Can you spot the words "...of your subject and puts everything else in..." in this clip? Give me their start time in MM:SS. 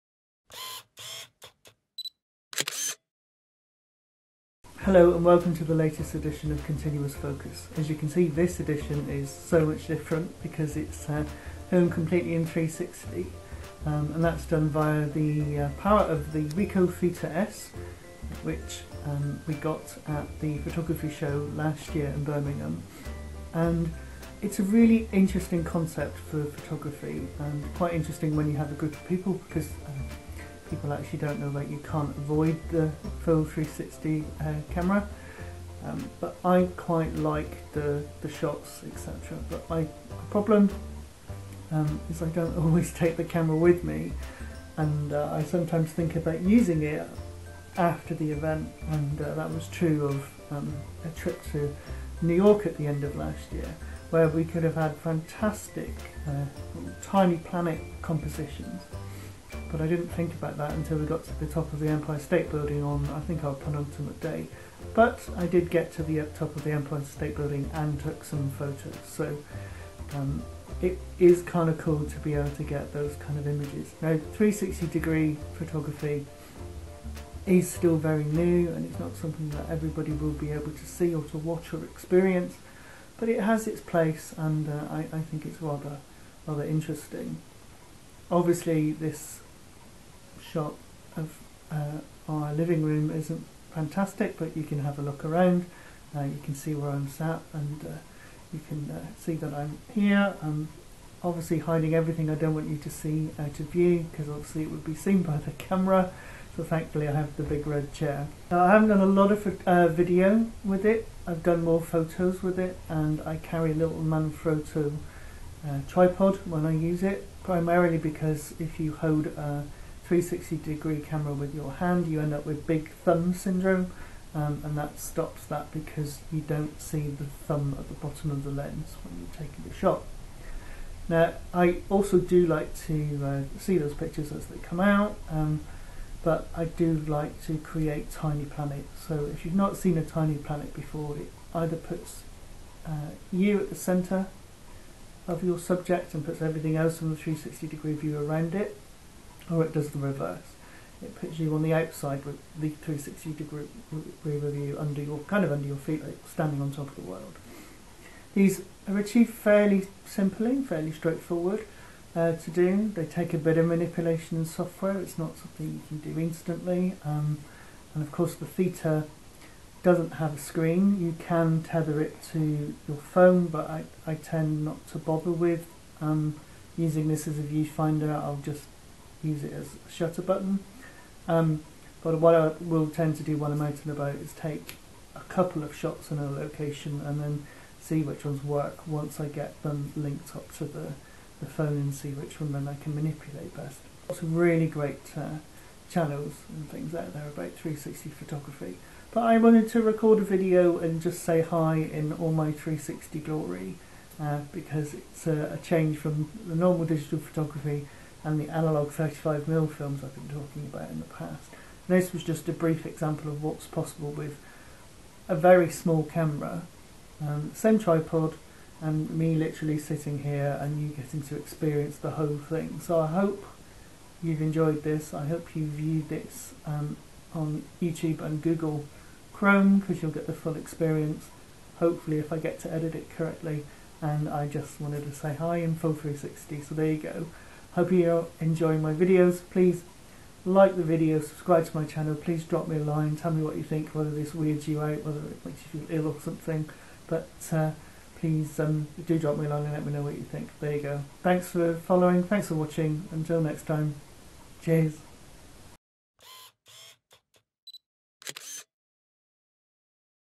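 02:25.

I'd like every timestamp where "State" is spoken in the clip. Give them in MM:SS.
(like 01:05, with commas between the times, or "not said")
01:02, 01:07.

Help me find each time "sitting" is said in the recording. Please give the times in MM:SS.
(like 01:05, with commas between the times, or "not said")
03:39.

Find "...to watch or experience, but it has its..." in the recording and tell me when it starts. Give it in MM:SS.
01:21.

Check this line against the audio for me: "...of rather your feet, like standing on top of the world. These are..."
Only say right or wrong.
wrong.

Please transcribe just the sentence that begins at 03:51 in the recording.
Hopefully if I get to edit it correctly and I just wanted to say hi in Full 360 so there you go.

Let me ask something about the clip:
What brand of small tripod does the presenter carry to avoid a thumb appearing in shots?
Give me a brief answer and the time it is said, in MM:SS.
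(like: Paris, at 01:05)
Manfrotto, at 01:54.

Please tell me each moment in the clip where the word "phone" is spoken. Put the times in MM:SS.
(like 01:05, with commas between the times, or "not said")
02:52, 03:11.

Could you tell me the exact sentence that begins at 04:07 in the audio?
But uh, please um, do drop me a line and let me know what you think.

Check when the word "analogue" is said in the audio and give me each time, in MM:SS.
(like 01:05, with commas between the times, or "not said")
03:28.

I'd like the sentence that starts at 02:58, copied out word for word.
I'll just use it as a shutter button.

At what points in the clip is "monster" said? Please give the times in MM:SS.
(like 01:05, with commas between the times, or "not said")
not said.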